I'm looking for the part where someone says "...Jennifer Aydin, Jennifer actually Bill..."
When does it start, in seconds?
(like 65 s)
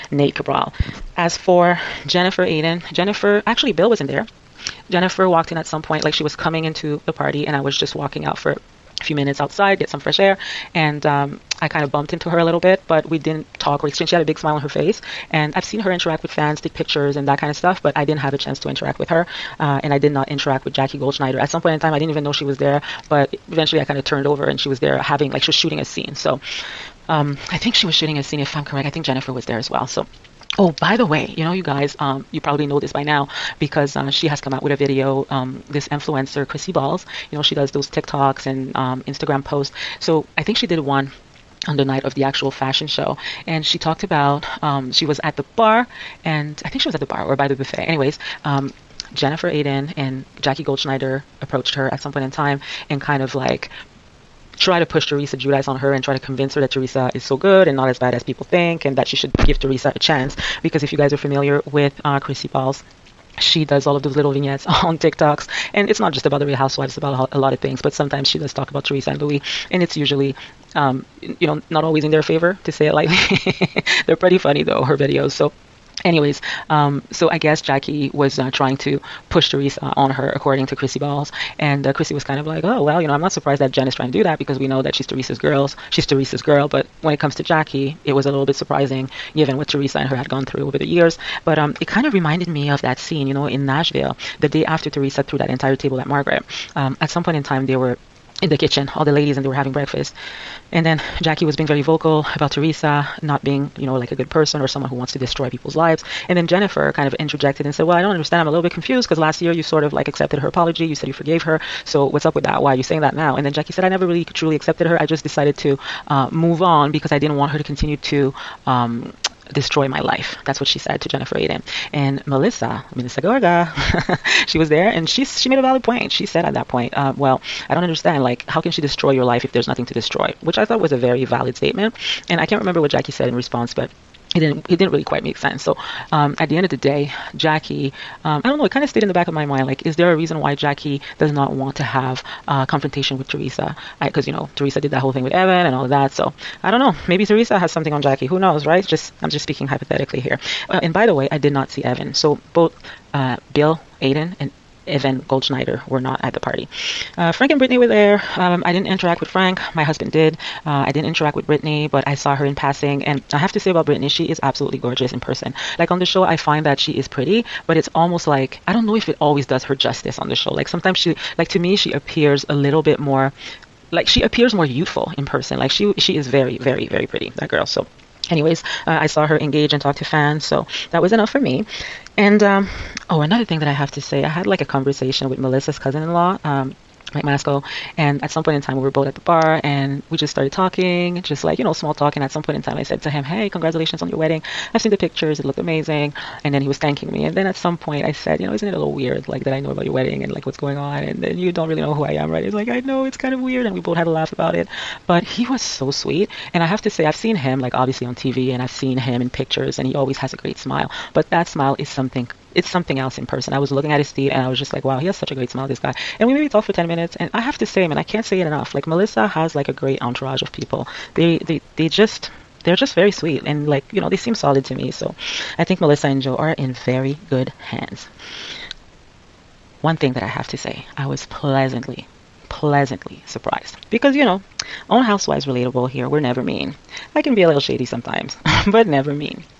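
2 s.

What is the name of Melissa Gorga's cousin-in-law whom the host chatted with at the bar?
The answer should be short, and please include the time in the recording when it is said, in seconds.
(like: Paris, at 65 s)
Mike Masco, at 187 s.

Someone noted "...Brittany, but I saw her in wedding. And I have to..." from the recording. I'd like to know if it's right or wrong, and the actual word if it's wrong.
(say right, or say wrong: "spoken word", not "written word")
wrong: "passing", not "wedding".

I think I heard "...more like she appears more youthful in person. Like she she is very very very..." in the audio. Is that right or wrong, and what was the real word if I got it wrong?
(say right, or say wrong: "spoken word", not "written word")
right.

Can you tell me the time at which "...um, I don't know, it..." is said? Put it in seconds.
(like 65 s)
138 s.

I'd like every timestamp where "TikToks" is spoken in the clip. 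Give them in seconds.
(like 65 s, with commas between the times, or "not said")
37 s, 64 s.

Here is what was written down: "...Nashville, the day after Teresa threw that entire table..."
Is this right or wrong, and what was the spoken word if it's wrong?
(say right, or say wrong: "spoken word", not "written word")
right.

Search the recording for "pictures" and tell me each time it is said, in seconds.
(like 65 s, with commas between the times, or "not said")
16 s, 194 s, 209 s.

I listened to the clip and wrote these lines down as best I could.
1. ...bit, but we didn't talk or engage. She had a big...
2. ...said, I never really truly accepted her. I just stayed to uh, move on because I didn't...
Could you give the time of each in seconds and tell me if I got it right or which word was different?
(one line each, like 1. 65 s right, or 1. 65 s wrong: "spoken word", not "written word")
1. 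12 s wrong: "exchange", not "engage"
2. 113 s wrong: "decided", not "stayed".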